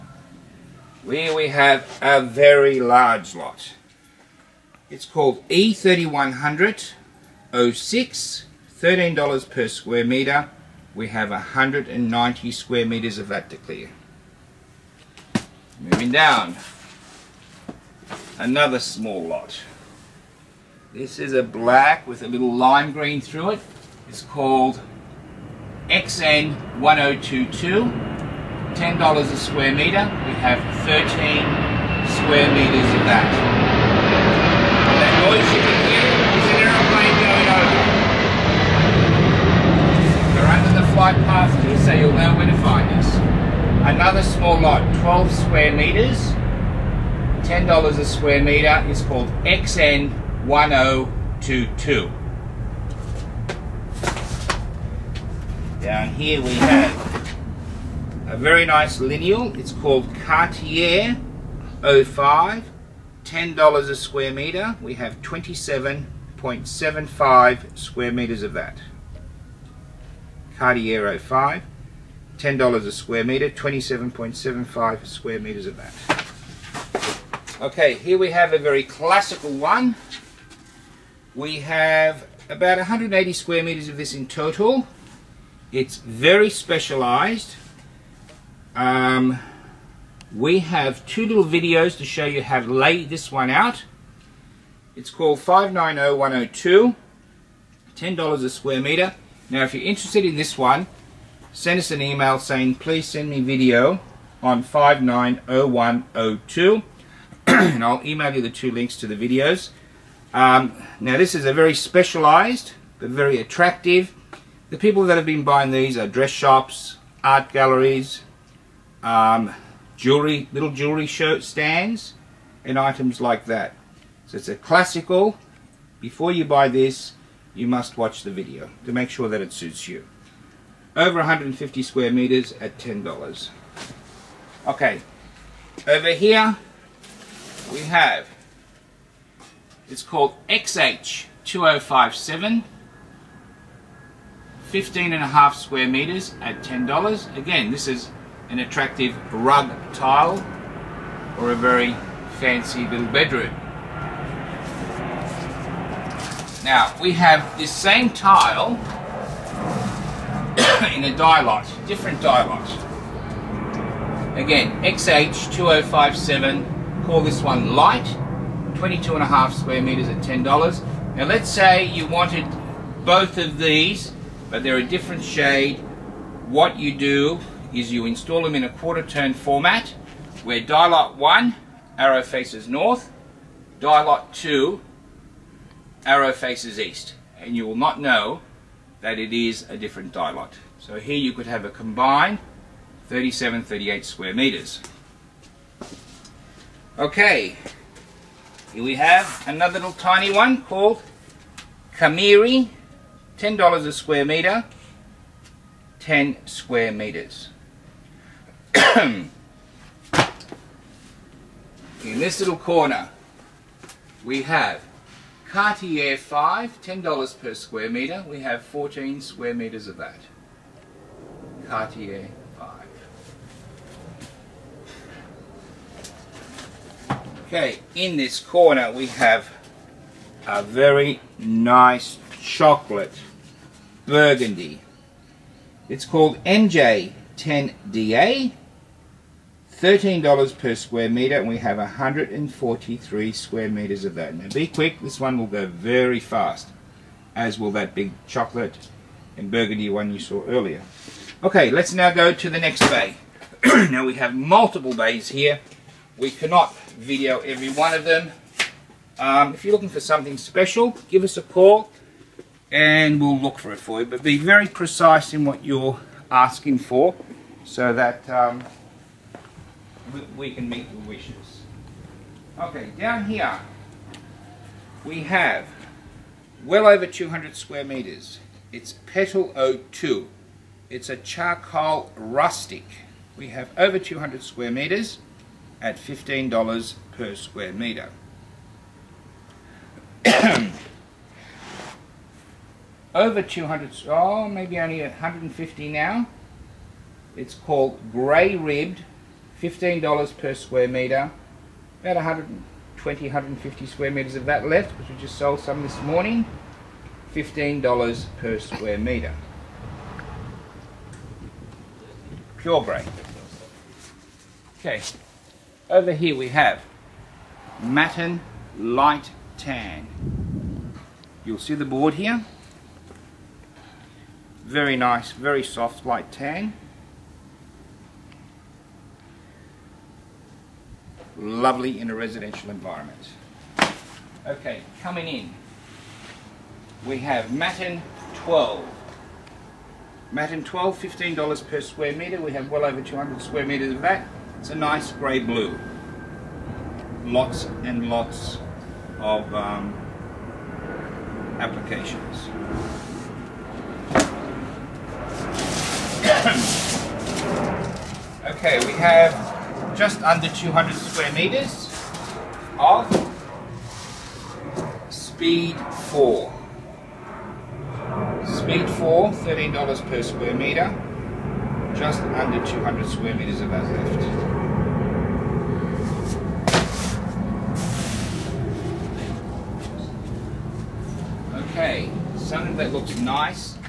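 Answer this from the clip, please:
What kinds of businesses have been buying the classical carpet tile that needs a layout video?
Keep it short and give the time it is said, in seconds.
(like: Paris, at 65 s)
Dress shops, at 116 s.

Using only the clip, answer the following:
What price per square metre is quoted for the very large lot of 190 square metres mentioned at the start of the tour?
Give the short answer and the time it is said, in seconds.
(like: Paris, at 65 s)
$13, at 8 s.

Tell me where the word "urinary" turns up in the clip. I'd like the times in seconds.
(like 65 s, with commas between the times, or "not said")
not said.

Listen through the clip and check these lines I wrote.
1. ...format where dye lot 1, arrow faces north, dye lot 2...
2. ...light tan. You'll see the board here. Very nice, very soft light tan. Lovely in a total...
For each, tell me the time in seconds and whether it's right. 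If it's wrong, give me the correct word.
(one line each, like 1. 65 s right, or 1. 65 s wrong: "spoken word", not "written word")
1. 179 s right
2. 318 s wrong: "residential", not "total".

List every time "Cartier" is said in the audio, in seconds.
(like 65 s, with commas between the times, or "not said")
60 s, 70 s, 215 s, 221 s.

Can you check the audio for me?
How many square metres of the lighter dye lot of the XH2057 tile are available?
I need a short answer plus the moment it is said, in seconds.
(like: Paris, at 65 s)
22.5 square metres, at 168 s.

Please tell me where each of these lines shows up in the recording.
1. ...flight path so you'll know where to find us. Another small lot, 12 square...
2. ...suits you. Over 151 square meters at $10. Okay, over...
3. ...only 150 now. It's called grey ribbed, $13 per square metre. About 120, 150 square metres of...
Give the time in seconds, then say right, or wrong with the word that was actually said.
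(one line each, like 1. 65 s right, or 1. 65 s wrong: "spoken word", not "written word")
1. 40 s right
2. 129 s wrong: "150", not "151"
3. 294 s wrong: "15", not "13".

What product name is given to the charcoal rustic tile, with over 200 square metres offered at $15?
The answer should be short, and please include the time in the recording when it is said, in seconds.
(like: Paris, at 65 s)
Petal 02, at 279 s.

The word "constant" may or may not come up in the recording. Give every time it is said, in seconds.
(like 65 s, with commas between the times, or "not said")
not said.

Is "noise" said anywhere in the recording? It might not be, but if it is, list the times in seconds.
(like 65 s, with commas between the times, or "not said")
35 s.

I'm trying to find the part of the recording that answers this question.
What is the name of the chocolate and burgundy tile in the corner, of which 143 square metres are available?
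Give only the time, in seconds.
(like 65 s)
236 s.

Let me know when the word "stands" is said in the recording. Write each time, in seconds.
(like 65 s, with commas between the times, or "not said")
121 s.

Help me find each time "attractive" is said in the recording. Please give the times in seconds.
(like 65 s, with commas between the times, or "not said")
113 s, 148 s.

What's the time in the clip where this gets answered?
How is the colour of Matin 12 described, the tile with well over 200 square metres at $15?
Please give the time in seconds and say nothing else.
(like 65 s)
345 s.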